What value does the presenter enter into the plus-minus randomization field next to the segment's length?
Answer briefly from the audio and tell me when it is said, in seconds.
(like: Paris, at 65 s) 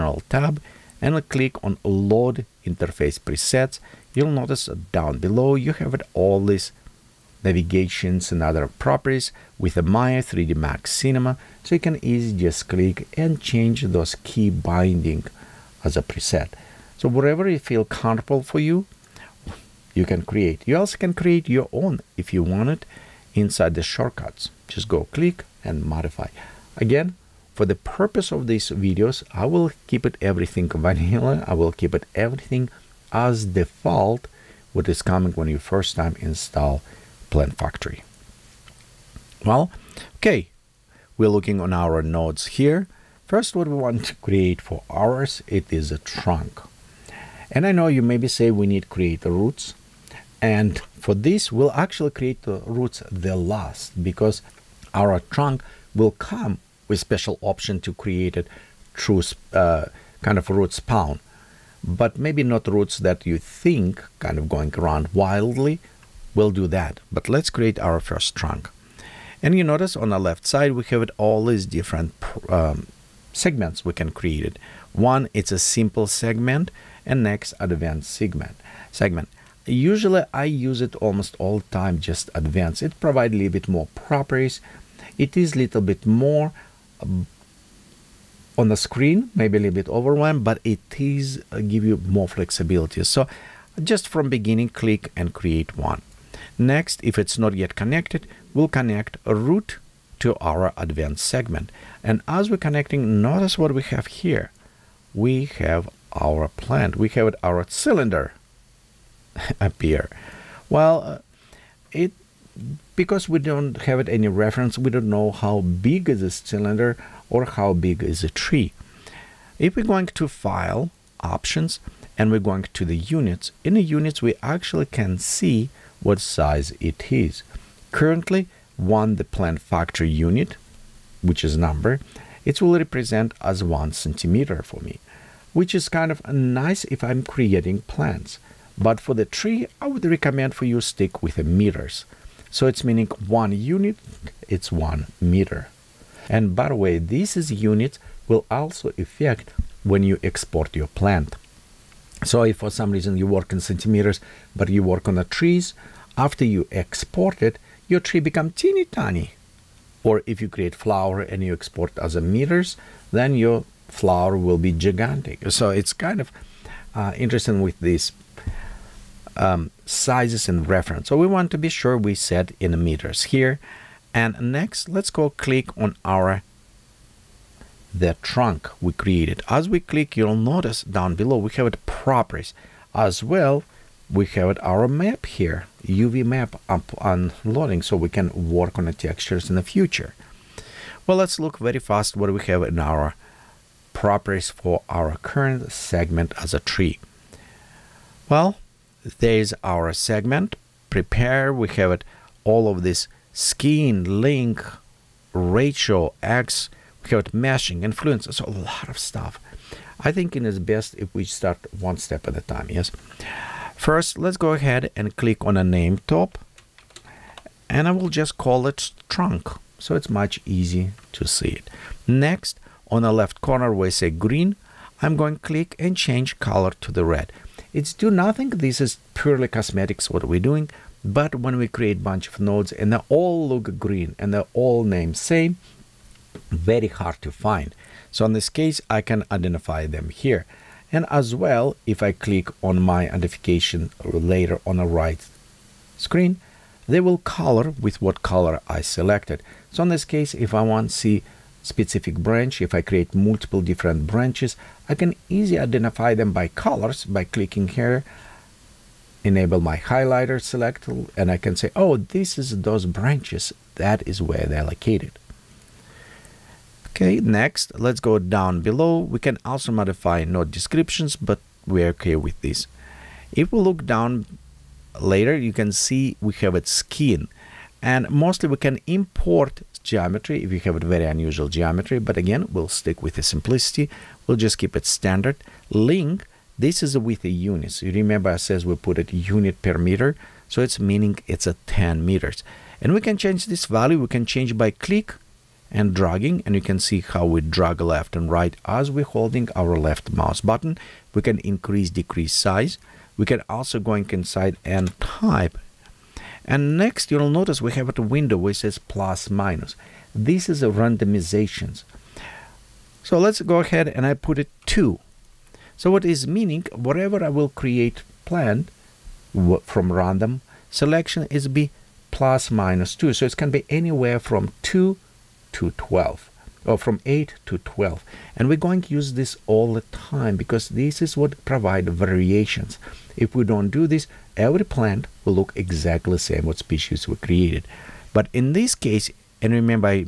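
2, at 314 s.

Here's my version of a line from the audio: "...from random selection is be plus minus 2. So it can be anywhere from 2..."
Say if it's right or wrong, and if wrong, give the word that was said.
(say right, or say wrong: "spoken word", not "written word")
right.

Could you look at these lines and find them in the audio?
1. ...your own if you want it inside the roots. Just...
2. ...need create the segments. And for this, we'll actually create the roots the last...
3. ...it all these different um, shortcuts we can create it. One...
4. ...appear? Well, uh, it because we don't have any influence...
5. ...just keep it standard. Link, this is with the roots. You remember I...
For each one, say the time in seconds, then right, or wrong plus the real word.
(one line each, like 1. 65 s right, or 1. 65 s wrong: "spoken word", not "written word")
1. 21 s wrong: "shortcuts", not "roots"
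2. 48 s wrong: "roots", not "segments"
3. 71 s wrong: "segments", not "shortcuts"
4. 109 s wrong: "reference", not "influence"
5. 284 s wrong: "units", not "roots".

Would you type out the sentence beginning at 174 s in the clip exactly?
And next, let's go click on our the trunk we created.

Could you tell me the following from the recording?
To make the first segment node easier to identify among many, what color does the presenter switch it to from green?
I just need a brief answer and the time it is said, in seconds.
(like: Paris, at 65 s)
red, at 225 s.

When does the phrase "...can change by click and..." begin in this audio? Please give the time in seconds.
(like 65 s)
294 s.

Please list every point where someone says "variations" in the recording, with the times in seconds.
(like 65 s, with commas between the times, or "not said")
331 s.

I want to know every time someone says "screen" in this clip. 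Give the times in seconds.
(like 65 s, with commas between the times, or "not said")
88 s, 245 s.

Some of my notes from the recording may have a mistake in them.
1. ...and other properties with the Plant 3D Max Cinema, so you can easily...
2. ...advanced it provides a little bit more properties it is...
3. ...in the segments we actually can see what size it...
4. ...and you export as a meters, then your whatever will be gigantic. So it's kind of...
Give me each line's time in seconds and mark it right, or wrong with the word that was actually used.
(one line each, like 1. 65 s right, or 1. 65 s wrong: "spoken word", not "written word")
1. 8 s wrong: "Maya", not "Plant"
2. 82 s right
3. 123 s wrong: "units", not "segments"
4. 161 s wrong: "flower", not "whatever".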